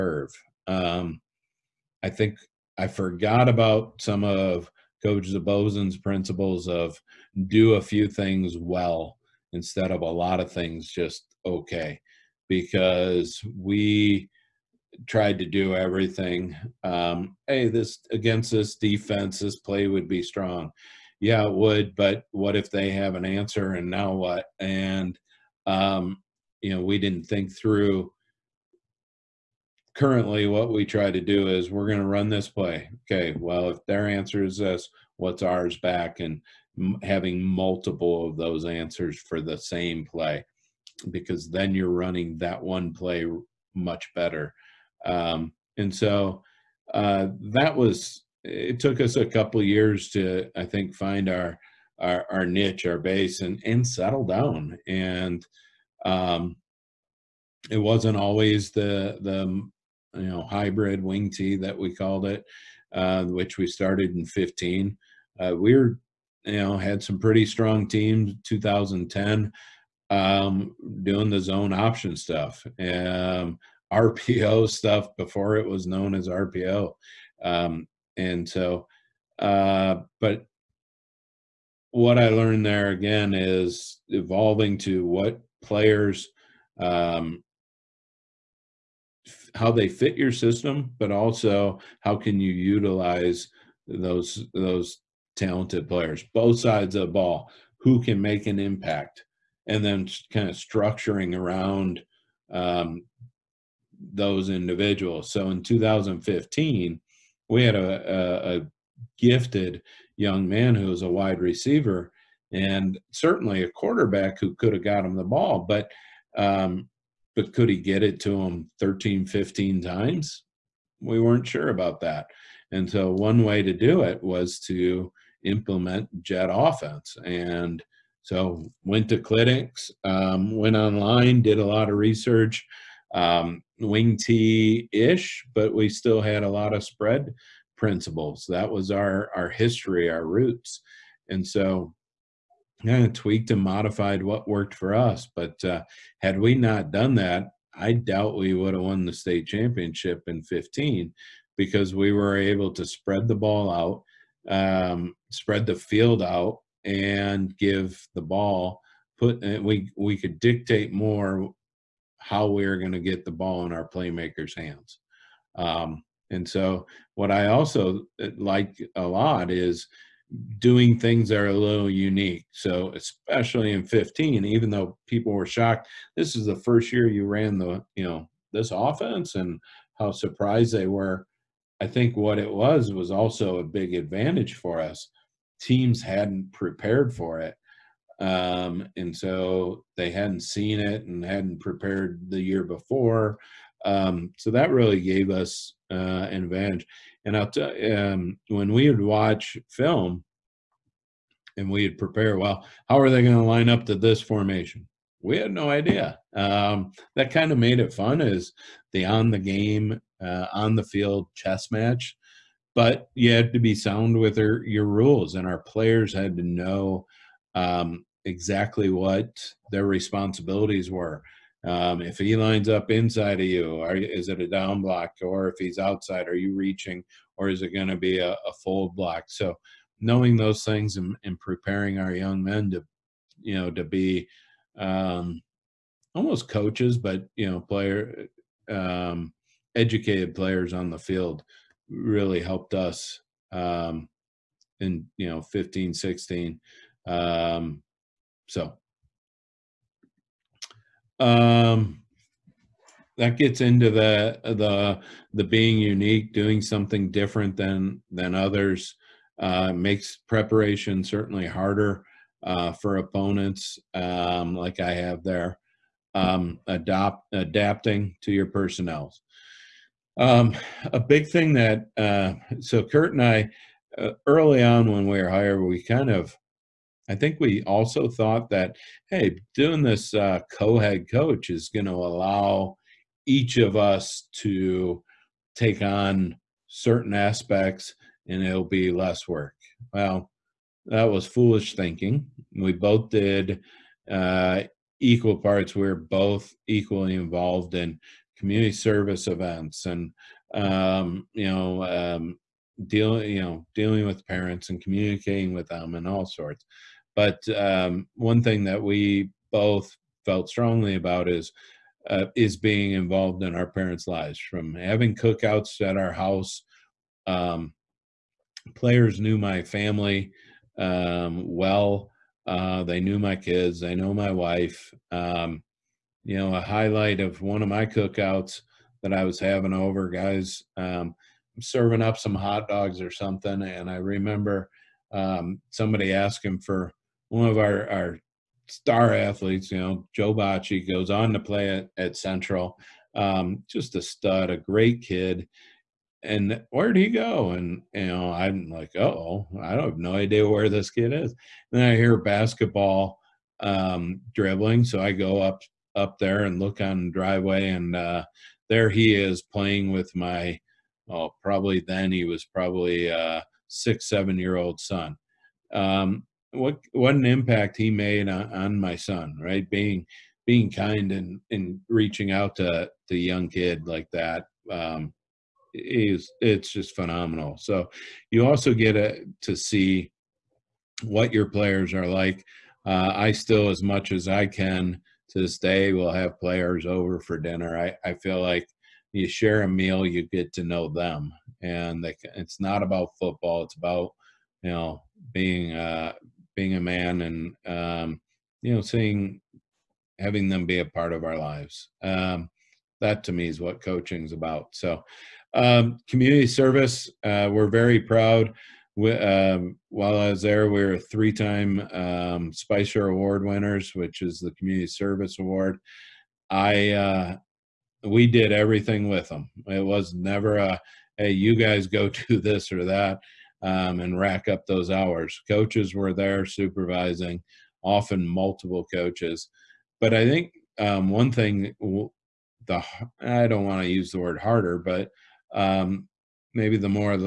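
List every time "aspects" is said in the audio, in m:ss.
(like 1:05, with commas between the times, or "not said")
4:47.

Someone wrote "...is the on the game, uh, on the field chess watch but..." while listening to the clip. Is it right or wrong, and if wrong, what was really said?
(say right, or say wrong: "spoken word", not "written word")
wrong: "match", not "watch".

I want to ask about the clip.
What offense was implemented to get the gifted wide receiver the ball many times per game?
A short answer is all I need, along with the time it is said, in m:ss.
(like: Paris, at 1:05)
jet offense, at 2:06.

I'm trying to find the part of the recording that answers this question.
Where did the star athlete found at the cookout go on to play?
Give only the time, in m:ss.
5:42.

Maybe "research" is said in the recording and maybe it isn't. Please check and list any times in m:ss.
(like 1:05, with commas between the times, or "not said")
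2:11.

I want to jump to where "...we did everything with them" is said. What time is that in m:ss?
6:58.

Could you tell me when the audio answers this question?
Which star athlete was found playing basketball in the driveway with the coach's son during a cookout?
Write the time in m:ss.
5:40.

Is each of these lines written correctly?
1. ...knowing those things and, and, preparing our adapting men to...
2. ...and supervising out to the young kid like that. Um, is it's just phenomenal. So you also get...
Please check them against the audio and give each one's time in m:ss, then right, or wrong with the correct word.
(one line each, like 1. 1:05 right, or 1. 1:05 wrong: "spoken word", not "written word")
1. 3:49 wrong: "young", not "adapting"
2. 6:11 wrong: "reaching", not "supervising".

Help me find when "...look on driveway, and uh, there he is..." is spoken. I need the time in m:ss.
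5:56.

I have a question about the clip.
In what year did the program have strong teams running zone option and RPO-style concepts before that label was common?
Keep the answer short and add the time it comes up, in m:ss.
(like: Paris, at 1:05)
2010, at 1:08.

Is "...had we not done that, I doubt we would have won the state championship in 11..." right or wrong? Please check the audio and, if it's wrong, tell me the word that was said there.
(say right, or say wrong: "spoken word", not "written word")
wrong: "15", not "11".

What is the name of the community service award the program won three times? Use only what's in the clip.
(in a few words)
Spicer Award.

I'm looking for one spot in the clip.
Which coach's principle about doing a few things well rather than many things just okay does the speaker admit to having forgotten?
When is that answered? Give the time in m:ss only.
0:05.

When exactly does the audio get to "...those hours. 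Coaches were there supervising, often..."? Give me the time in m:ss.
7:04.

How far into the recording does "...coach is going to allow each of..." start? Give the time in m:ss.
4:41.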